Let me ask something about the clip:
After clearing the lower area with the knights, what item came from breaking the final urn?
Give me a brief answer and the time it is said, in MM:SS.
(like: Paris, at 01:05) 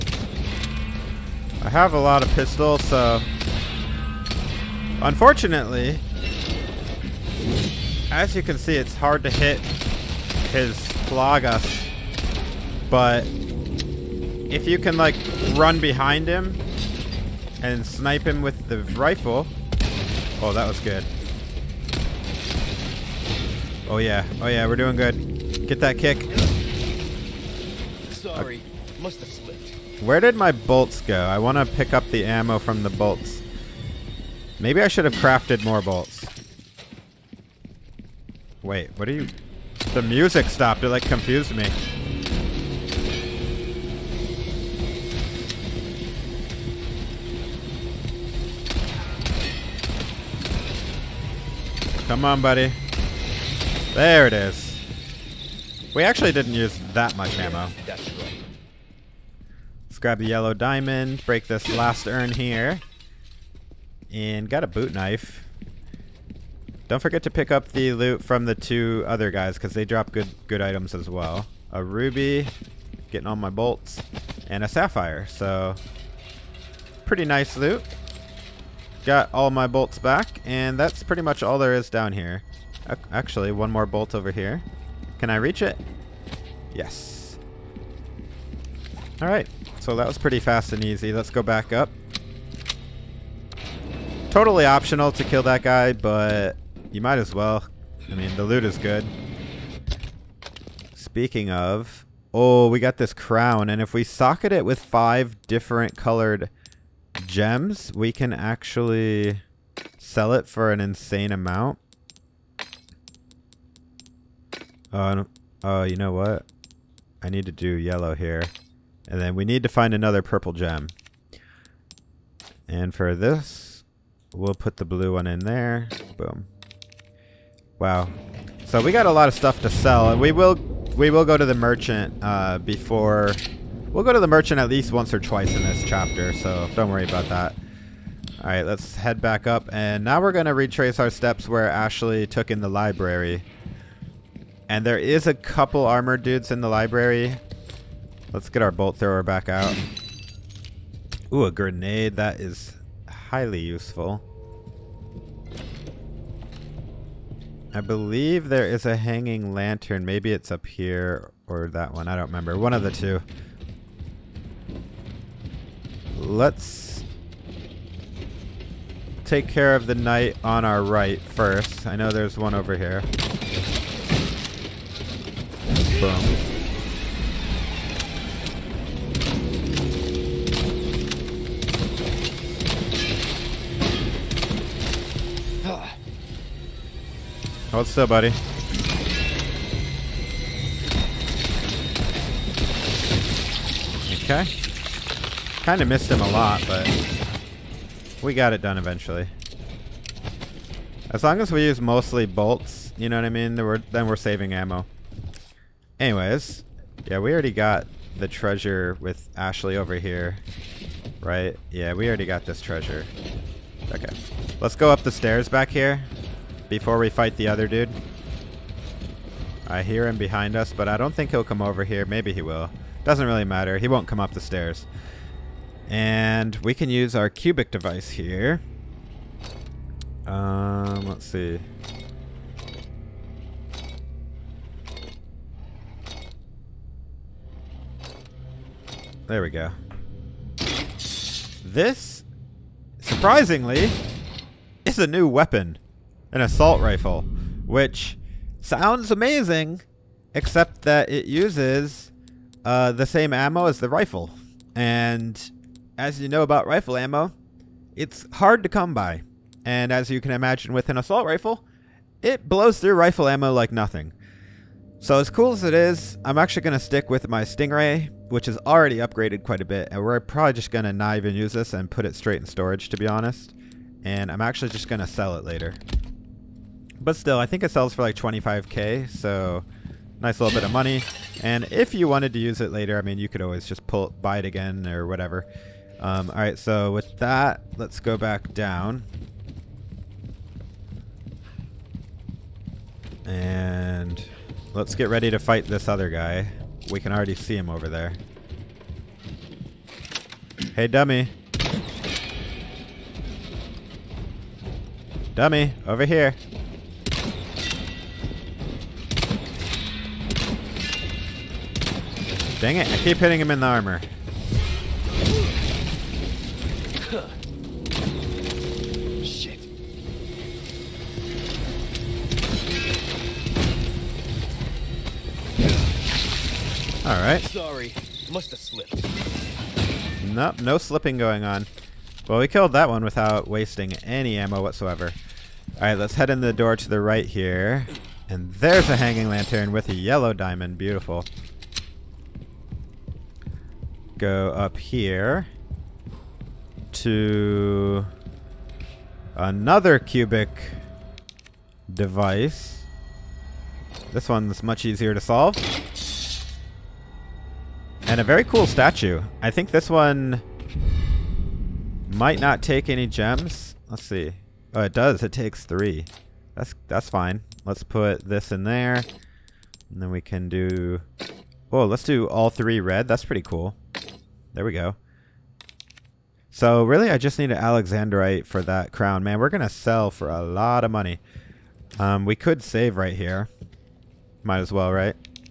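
Boot knife, at 01:04.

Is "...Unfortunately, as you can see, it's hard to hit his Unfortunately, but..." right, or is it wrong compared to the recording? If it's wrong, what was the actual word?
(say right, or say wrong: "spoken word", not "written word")
wrong: "Plagas", not "Unfortunately".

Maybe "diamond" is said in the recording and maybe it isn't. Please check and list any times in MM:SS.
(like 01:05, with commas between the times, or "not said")
01:00, 05:40.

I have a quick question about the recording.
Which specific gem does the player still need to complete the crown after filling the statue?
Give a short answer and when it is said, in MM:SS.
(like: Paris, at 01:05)
Alexandrite, at 06:17.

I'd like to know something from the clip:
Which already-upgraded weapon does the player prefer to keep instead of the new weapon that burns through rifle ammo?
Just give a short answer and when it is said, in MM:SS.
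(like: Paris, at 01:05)
Stingray, at 04:27.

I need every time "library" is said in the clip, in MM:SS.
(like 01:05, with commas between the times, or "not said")
02:22, 02:26.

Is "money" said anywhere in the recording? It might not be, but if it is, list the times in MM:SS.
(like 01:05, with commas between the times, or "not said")
04:40, 06:20.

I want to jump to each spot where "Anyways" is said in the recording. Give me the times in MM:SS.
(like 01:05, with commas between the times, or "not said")
03:25.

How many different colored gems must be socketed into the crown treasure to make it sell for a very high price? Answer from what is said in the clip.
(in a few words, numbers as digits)
5.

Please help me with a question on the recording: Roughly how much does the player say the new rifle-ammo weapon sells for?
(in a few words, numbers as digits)
25k.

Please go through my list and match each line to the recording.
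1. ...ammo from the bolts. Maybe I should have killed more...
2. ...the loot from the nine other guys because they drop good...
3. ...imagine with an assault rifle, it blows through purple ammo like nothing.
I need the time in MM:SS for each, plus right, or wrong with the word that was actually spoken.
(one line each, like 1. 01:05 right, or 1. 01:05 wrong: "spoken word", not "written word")
1. 00:32 wrong: "crafted", not "killed"
2. 01:07 wrong: "two", not "nine"
3. 04:20 wrong: "rifle", not "purple".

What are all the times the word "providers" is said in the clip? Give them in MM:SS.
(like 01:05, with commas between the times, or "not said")
not said.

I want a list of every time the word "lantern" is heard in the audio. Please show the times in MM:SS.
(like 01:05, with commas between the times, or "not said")
02:39, 05:39.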